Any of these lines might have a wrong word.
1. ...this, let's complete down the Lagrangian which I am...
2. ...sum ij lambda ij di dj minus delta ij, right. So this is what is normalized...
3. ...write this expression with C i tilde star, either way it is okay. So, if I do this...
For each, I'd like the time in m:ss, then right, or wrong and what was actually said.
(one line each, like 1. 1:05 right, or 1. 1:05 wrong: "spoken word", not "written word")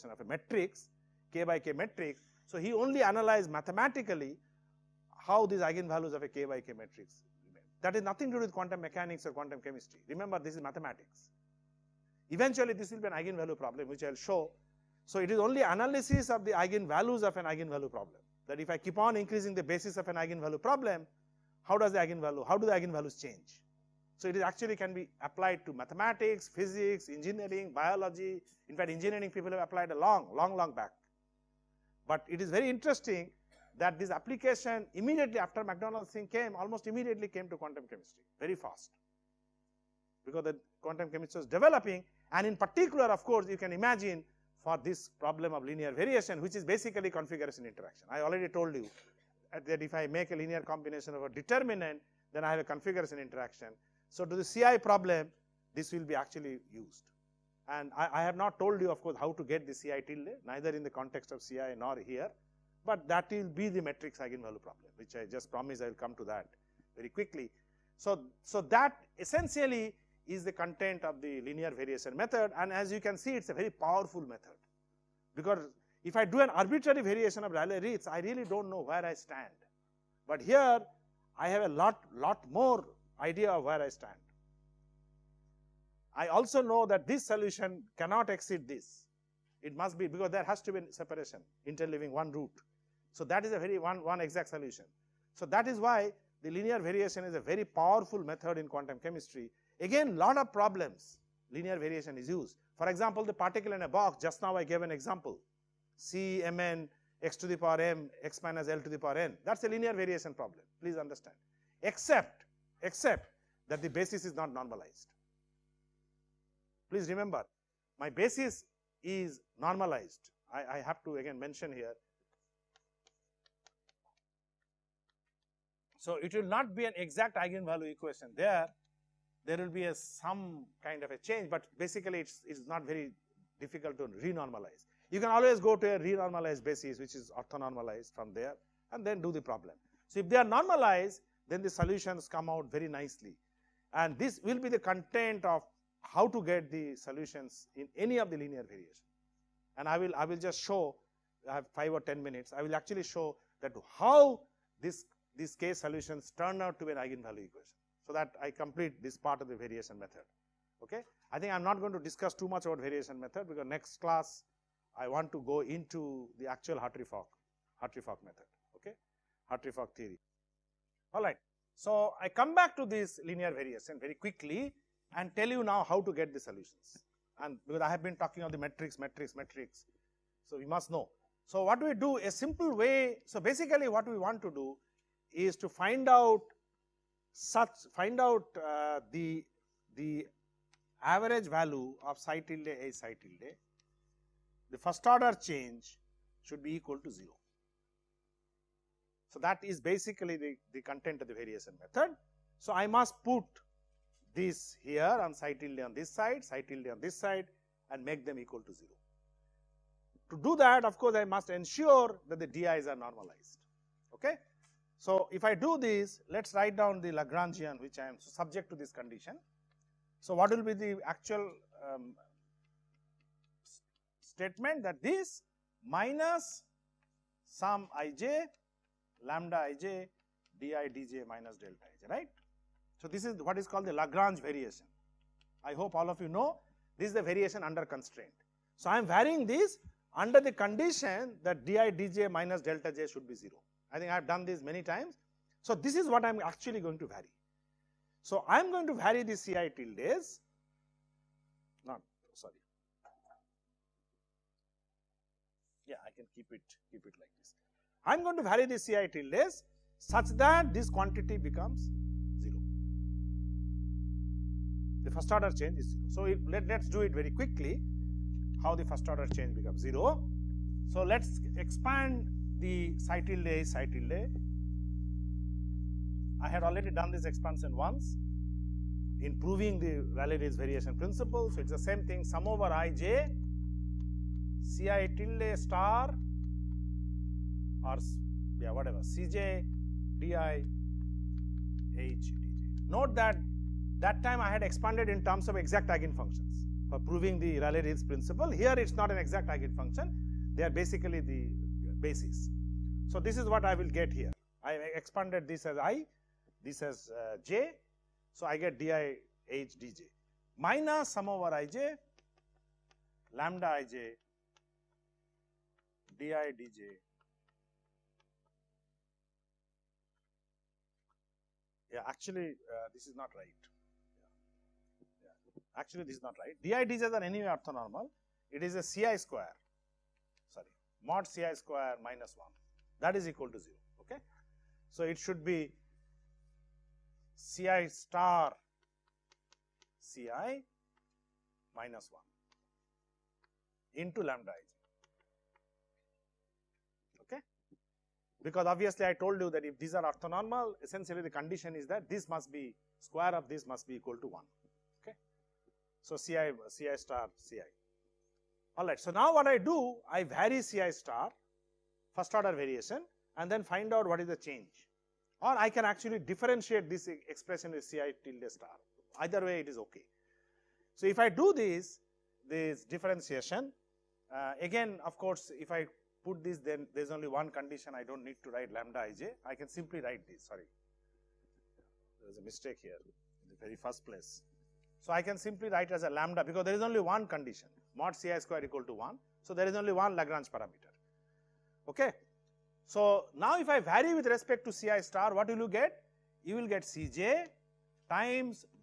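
1. 3:35 wrong: "write", not "complete"
2. 3:47 wrong: "called", not "normalized"
3. 6:06 wrong: "differentiate", not "write".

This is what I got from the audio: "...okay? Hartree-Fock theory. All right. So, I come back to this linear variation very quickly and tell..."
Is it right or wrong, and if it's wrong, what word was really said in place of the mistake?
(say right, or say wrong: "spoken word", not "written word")
right.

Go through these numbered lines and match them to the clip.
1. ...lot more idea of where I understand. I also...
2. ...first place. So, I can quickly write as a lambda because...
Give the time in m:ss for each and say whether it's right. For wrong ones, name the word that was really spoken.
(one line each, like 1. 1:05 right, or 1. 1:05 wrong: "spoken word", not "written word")
1. 1:22 wrong: "stand", not "understand"
2. 6:23 wrong: "simply", not "quickly".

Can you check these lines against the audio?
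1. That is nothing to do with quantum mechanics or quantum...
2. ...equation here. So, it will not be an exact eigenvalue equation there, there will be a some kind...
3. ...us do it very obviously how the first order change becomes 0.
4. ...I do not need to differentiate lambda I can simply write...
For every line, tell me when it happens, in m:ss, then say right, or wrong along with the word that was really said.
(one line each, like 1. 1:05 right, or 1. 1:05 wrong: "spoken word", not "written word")
1. 0:07 right
2. 2:01 wrong: "mention", not "equation"
3. 4:26 wrong: "quickly", not "obviously"
4. 6:17 wrong: "write", not "differentiate".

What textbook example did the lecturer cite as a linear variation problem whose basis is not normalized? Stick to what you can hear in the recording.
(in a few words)
Particle in a box.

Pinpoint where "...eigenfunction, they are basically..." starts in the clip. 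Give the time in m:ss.
4:59.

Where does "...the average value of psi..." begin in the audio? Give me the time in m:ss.
3:09.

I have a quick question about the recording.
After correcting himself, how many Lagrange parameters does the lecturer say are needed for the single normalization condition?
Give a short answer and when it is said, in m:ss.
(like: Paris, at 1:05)
1, at 6:29.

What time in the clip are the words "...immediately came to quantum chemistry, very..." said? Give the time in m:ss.
0:36.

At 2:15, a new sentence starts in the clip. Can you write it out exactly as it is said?
You can always go to a renormalized basis, which is orthonormalized from there, and then do the problem.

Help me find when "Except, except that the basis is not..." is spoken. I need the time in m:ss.
1:51.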